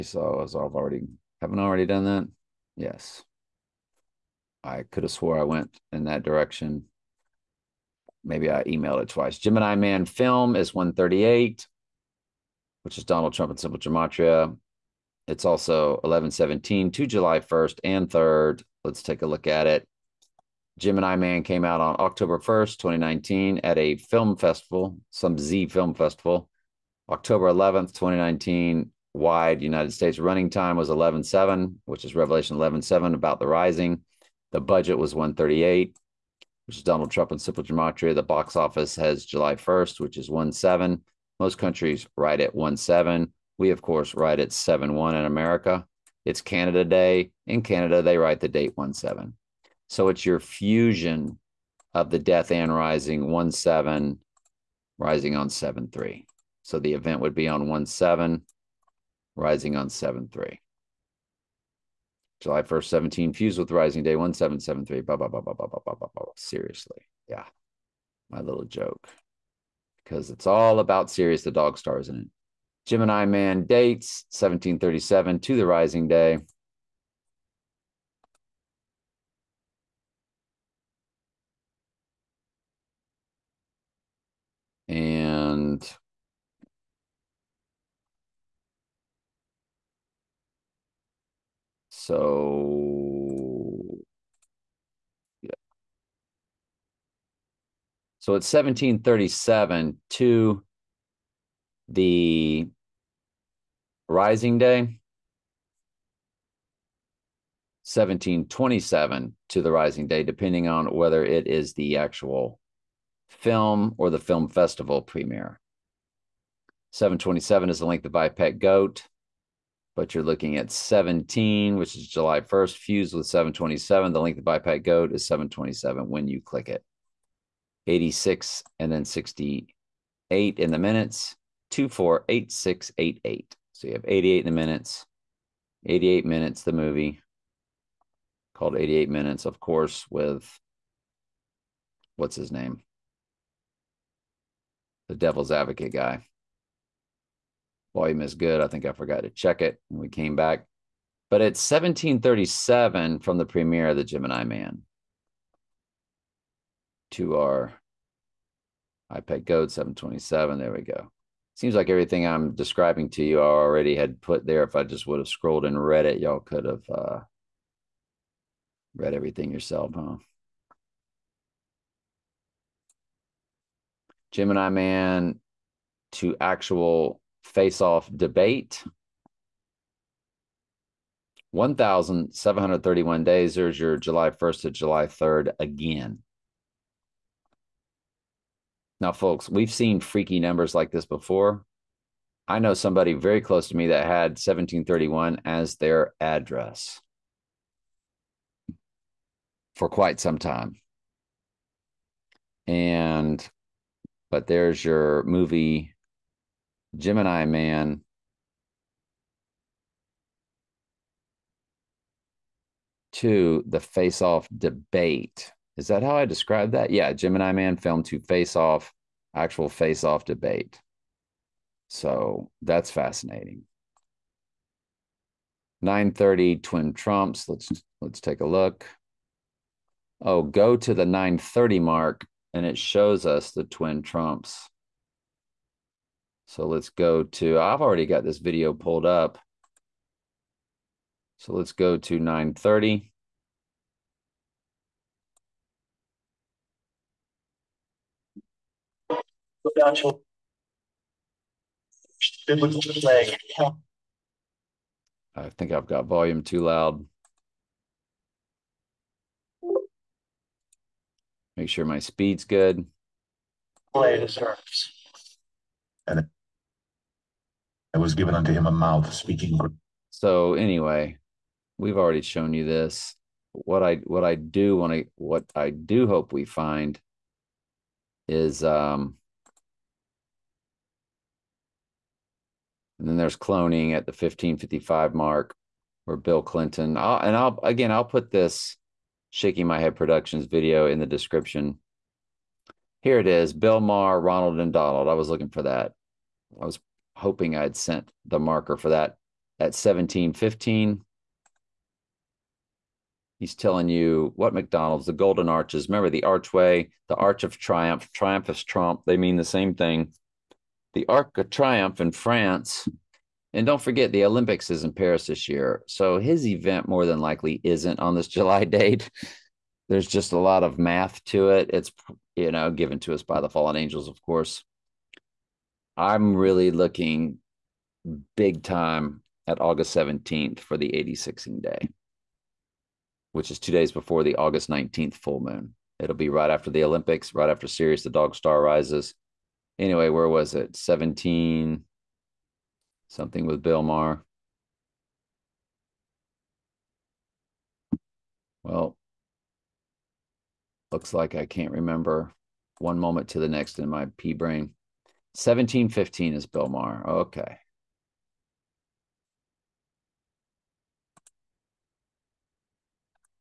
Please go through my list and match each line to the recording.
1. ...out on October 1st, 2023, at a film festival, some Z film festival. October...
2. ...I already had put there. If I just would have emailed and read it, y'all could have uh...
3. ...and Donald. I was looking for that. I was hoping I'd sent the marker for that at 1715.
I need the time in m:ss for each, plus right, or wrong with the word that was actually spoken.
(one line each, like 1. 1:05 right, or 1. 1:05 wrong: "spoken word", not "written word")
1. 0:21 wrong: "2019", not "2023"
2. 2:43 wrong: "scrolled", not "emailed"
3. 4:54 right.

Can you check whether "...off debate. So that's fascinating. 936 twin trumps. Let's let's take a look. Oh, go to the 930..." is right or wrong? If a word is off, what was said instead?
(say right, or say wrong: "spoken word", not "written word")
wrong: "930", not "936".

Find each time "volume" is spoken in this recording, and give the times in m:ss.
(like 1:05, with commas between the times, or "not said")
2:27, 4:16.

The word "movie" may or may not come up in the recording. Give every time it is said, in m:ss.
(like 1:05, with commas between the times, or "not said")
2:16, 3:25.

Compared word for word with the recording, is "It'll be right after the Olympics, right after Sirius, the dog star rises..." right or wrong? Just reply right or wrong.
right.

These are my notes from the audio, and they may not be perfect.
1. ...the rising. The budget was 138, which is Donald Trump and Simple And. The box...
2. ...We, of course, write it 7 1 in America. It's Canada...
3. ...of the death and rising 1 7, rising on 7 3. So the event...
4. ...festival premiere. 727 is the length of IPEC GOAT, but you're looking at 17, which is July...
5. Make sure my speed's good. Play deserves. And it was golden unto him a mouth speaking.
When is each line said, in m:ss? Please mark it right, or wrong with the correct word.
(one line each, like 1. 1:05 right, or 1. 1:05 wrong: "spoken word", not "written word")
1. 0:33 wrong: "Gematria", not "And"
2. 0:43 right
3. 0:51 right
4. 1:54 right
5. 4:21 wrong: "given", not "golden".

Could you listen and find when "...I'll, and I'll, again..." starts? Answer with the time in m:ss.
4:46.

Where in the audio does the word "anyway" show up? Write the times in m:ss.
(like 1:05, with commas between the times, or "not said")
4:30, 5:39.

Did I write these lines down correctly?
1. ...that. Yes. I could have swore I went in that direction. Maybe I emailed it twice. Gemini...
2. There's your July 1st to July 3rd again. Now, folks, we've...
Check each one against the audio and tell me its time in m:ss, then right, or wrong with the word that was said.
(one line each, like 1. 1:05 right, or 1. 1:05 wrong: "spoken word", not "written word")
1. 0:02 right
2. 3:03 right.